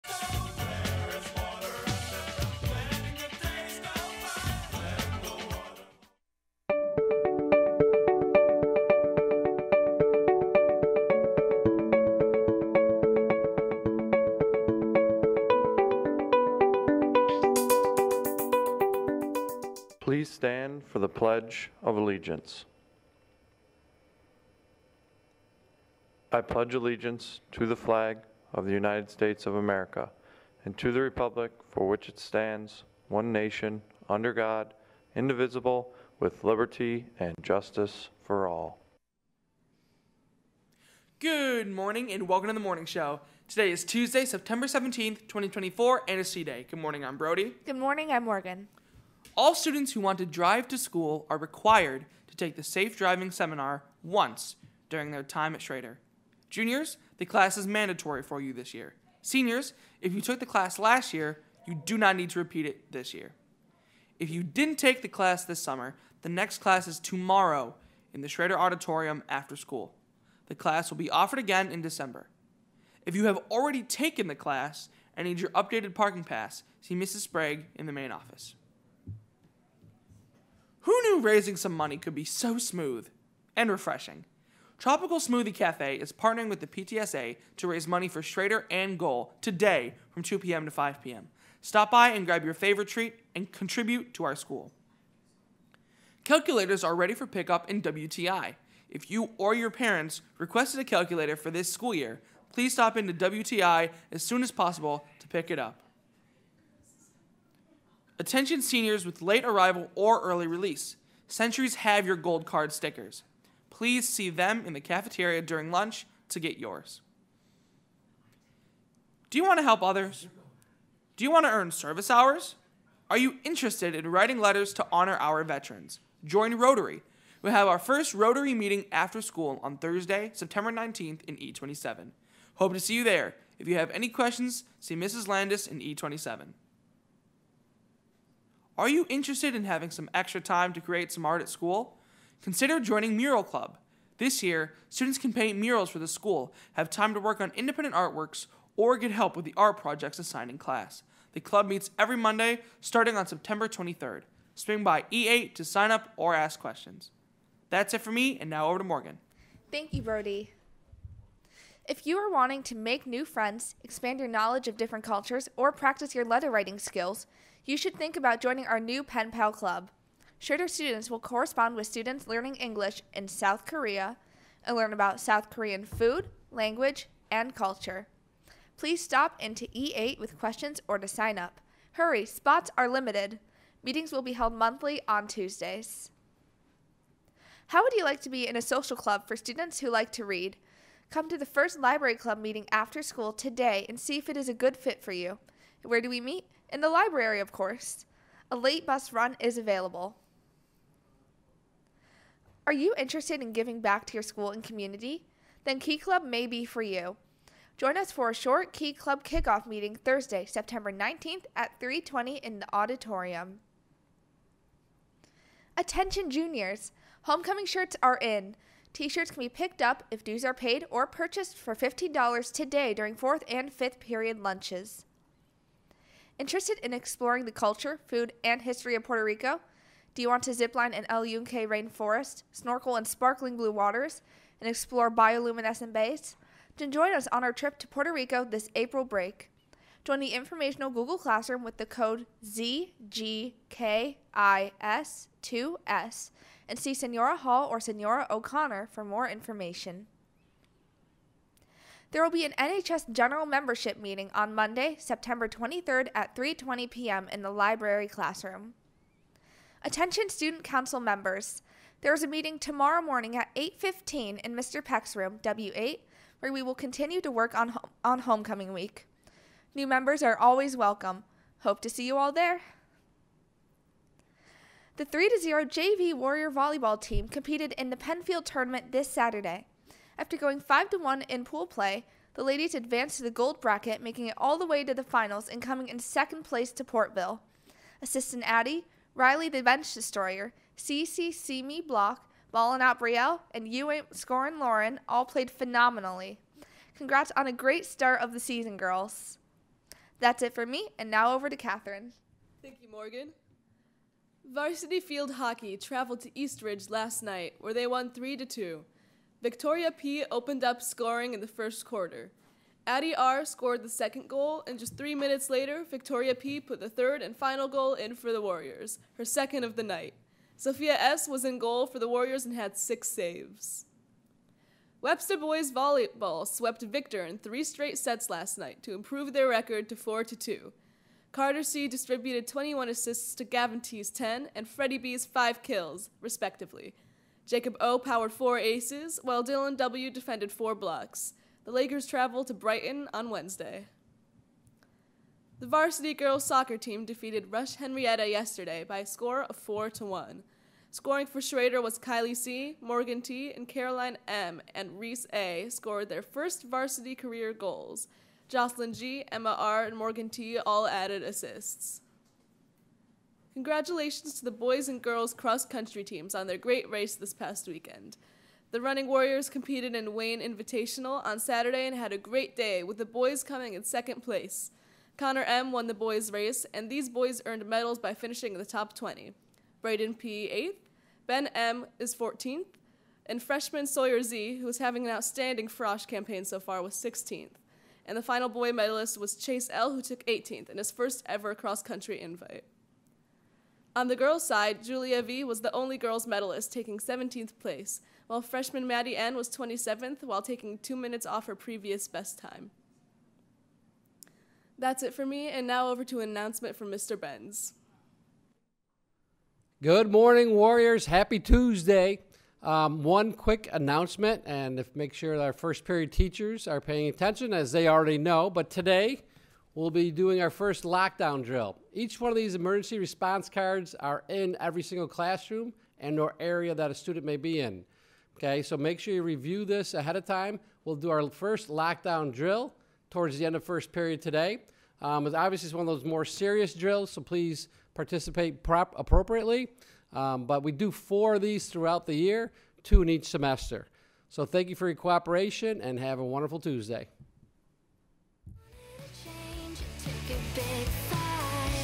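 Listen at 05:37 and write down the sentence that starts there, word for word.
Jacob O powered four aces, while Dylan W defended four blocks.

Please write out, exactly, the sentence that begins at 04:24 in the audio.
Peck's room, W8, where we will continue to work on on homecoming week.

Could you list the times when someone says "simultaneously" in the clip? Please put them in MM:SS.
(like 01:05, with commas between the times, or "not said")
not said.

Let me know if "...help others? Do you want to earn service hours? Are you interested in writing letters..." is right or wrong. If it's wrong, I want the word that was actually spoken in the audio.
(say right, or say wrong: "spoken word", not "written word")
right.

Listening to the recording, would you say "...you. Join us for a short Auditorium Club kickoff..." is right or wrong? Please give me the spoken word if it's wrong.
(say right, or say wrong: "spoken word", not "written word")
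wrong: "Key", not "Auditorium".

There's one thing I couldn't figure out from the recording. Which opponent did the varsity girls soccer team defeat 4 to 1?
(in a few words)
Rush Henrietta.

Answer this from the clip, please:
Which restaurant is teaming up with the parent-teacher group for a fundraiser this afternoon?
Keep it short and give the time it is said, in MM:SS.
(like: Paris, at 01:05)
Tropical Smoothie Cafe, at 01:24.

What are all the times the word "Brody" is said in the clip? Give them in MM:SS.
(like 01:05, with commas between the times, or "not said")
00:47, 02:40.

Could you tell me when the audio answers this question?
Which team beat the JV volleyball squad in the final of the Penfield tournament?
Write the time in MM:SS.
04:46.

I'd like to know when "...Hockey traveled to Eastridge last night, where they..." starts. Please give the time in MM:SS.
05:05.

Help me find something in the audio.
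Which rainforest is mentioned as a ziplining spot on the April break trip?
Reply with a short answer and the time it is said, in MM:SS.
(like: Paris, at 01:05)
El Yunque, at 03:51.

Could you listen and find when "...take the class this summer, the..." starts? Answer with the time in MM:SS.
01:04.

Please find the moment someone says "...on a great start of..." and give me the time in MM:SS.
04:57.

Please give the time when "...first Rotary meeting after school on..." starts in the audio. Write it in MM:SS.
02:07.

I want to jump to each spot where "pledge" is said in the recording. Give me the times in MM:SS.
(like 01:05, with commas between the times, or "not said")
00:21, 00:26.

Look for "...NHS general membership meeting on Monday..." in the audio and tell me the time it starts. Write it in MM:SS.
04:12.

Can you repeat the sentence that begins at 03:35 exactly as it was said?
Attention juniors, homecoming shirts are in.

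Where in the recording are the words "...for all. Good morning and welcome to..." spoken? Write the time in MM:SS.
00:38.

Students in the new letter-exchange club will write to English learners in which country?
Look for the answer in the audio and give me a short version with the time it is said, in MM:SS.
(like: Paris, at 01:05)
South Korea, at 02:53.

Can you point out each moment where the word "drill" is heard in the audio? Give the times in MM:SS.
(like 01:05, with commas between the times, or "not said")
07:01, 07:12, 07:16.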